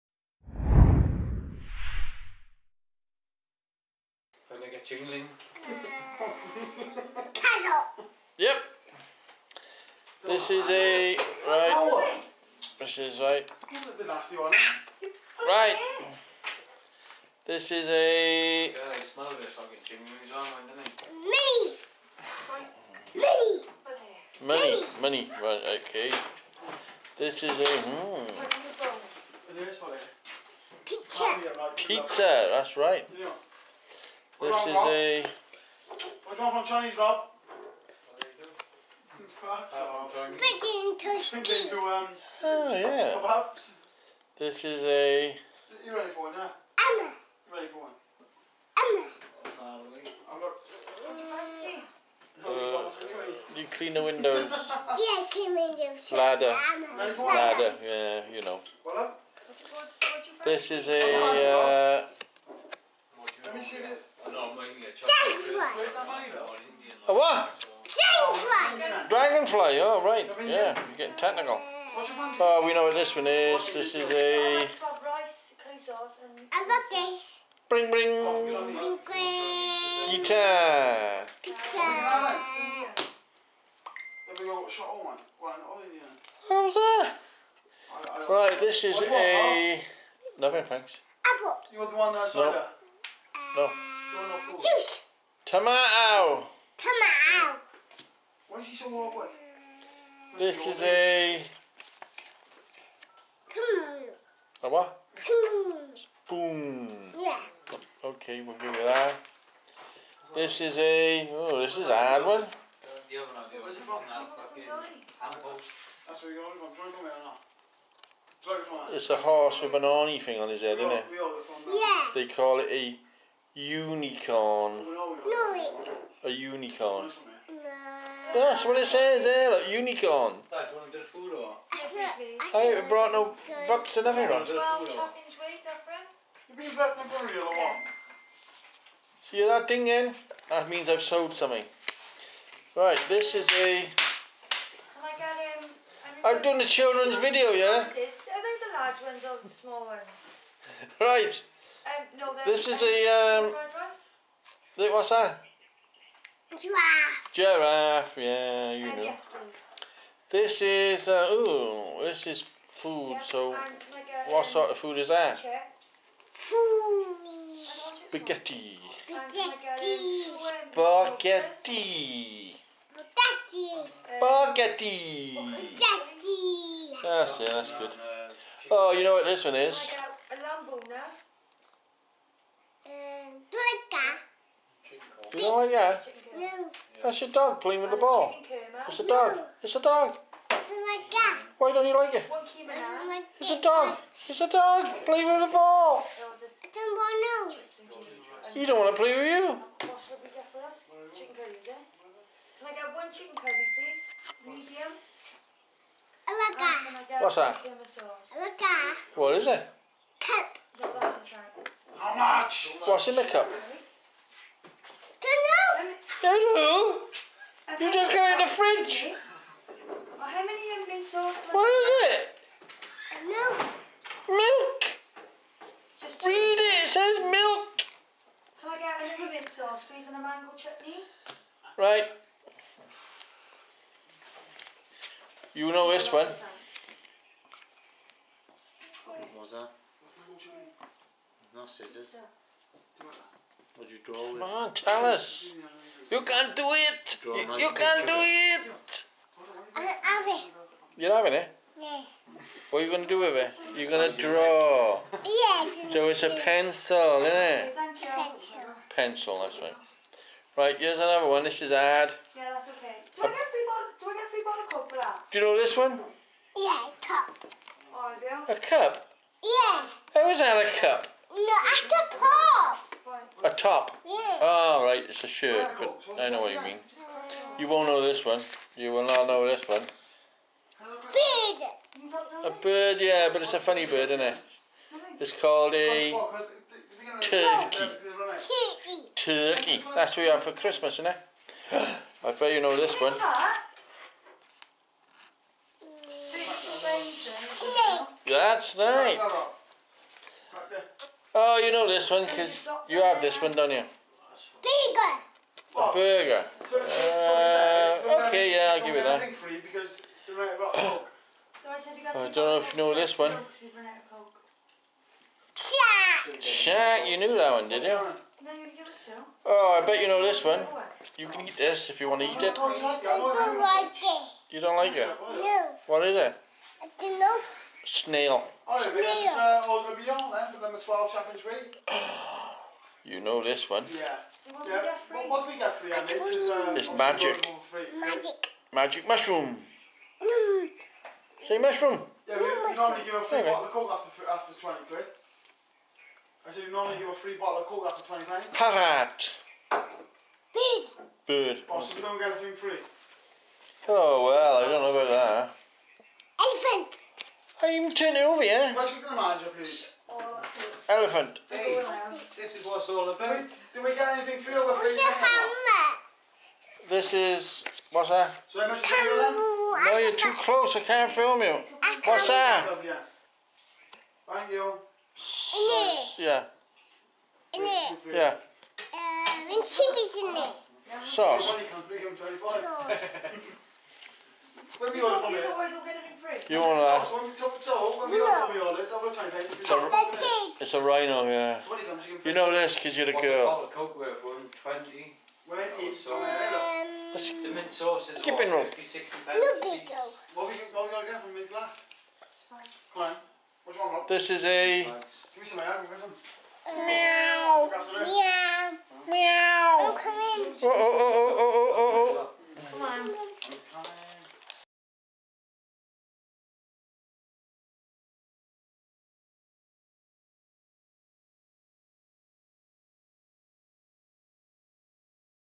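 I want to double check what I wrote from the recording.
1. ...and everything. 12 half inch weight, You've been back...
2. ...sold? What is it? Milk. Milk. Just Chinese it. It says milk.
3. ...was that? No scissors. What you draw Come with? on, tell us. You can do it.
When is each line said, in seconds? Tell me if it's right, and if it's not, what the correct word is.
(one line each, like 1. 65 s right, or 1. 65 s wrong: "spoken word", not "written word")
1. 133 s right
2. 221 s wrong: "Read", not "Chinese"
3. 239 s right.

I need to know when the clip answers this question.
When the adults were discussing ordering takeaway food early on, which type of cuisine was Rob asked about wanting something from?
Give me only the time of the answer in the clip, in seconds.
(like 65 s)
36 s.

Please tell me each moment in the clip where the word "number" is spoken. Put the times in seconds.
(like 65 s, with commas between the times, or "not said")
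330 s.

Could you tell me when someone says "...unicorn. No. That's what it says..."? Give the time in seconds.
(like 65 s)
126 s.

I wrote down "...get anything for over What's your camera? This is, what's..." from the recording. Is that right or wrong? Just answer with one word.
right.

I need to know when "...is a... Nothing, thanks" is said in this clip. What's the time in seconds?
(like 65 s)
88 s.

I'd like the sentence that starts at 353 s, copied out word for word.
Oh, well, I don't know about that.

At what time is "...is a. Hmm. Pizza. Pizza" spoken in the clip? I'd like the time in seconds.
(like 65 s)
27 s.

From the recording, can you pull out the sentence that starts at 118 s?
It's a horse with an army thing on his head, isn't it?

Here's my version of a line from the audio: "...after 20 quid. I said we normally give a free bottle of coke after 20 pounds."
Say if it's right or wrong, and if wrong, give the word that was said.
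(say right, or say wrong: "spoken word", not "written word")
right.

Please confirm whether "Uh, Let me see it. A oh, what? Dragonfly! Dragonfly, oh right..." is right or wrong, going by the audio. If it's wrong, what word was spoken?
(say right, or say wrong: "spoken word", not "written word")
right.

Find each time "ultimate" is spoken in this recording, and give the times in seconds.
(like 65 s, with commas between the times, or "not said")
not said.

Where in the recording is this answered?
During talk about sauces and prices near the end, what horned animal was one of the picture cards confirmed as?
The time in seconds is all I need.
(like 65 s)
390 s.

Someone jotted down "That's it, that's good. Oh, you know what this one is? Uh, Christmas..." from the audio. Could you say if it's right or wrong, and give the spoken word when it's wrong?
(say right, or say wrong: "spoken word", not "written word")
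wrong: "You", not "Christmas".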